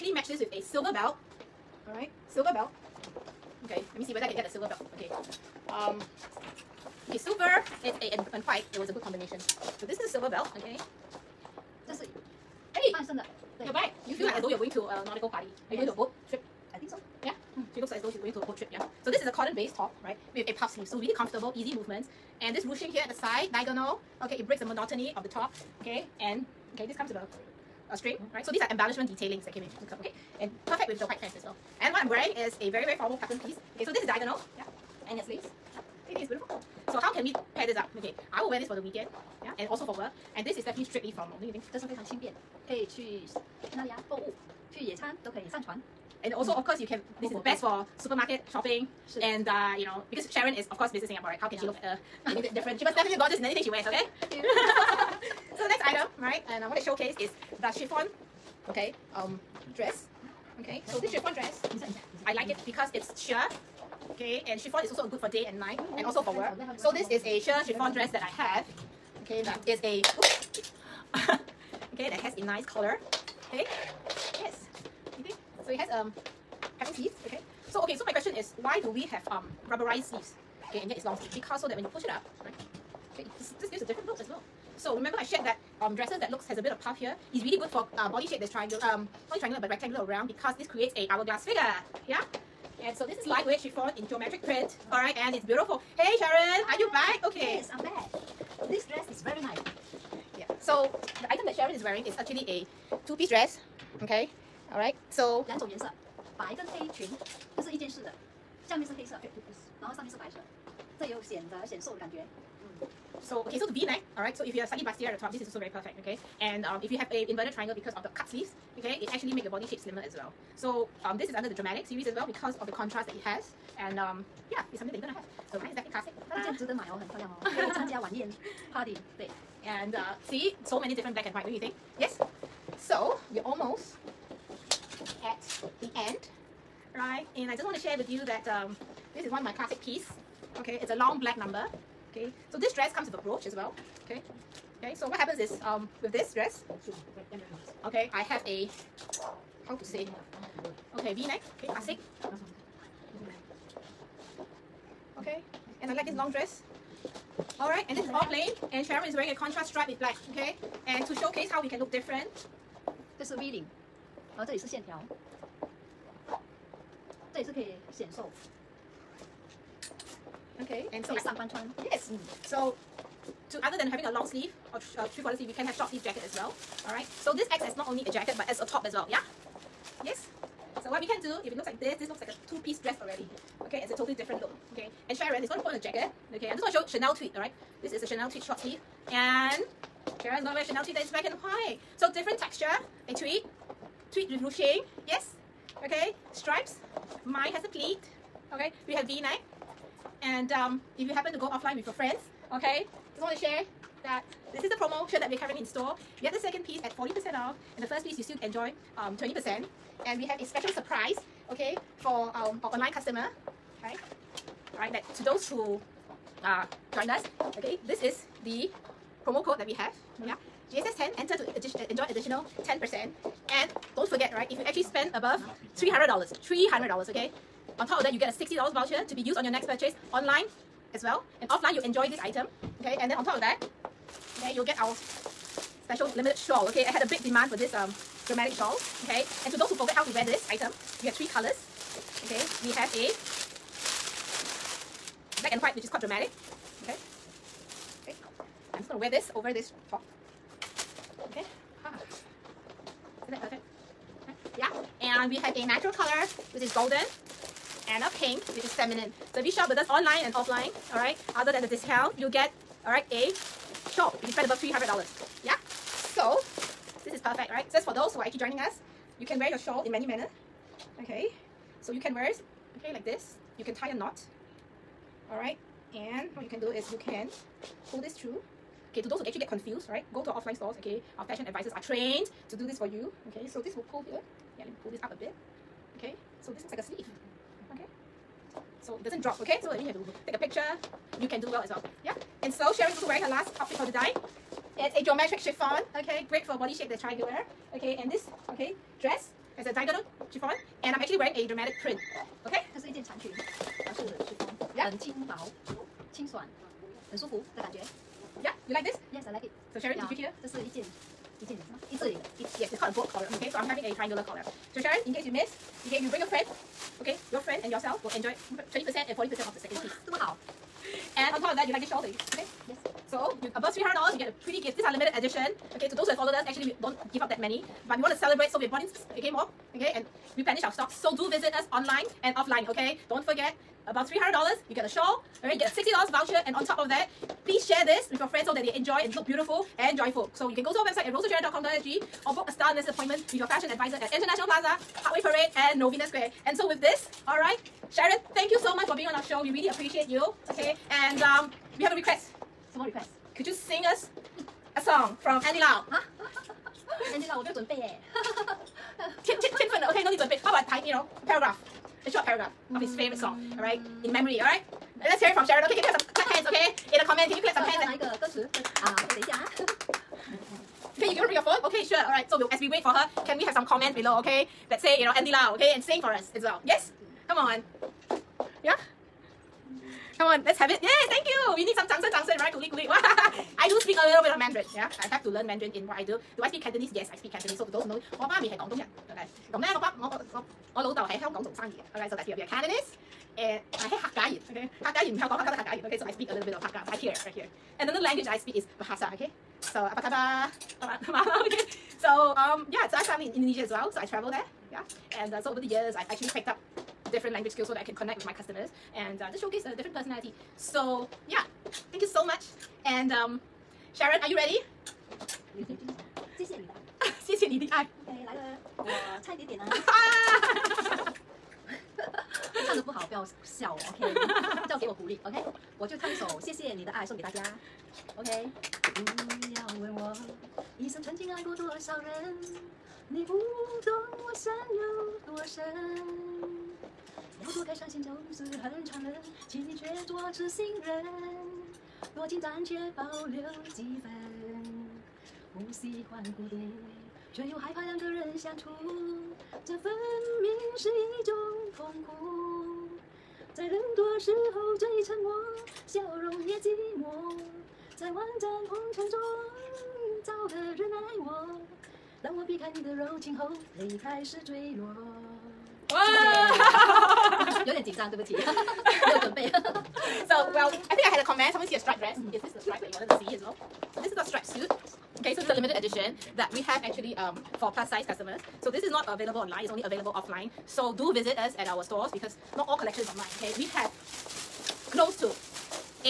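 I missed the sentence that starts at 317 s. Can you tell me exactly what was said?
Okay, your friend and yourself will enjoy 20% and 40% of the second piece.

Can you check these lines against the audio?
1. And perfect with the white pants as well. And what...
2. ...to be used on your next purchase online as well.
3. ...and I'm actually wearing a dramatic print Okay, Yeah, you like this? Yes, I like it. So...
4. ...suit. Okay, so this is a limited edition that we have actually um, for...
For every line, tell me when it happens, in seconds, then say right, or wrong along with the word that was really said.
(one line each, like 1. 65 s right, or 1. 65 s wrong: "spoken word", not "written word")
1. 30 s right
2. 229 s right
3. 300 s right
4. 474 s right.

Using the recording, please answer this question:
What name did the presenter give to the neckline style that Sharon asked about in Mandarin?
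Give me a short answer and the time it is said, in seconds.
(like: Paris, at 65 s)
boat collar, at 312 s.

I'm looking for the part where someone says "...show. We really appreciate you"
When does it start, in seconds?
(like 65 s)
349 s.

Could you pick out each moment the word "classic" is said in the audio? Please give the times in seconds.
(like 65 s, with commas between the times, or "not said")
125 s, 139 s, 151 s.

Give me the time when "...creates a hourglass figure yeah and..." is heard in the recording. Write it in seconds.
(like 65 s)
90 s.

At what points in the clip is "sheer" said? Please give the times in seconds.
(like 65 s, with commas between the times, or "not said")
63 s, 67 s.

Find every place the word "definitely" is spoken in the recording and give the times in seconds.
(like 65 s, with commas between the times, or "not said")
40 s, 52 s, 125 s.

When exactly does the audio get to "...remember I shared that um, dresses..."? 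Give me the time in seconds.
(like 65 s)
84 s.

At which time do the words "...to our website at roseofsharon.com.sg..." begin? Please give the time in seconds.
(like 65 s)
340 s.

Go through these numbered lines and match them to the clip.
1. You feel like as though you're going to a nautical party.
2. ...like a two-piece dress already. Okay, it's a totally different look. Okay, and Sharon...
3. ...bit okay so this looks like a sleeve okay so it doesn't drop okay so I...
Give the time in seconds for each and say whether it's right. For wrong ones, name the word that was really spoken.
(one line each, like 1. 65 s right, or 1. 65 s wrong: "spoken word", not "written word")
1. 14 s right
2. 182 s right
3. 285 s right.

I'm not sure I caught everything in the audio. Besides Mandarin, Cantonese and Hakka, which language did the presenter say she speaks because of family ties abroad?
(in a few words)
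Bahasa.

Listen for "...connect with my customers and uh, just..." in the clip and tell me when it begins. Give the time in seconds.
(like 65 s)
407 s.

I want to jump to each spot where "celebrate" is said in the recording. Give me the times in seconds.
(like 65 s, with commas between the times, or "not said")
328 s.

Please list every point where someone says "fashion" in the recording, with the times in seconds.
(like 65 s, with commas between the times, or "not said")
281 s, 343 s.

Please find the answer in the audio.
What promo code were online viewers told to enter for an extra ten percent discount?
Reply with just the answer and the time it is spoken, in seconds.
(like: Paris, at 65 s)
GSS 10, at 220 s.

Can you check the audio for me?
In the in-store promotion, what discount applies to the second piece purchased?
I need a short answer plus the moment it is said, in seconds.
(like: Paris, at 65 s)
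40%, at 206 s.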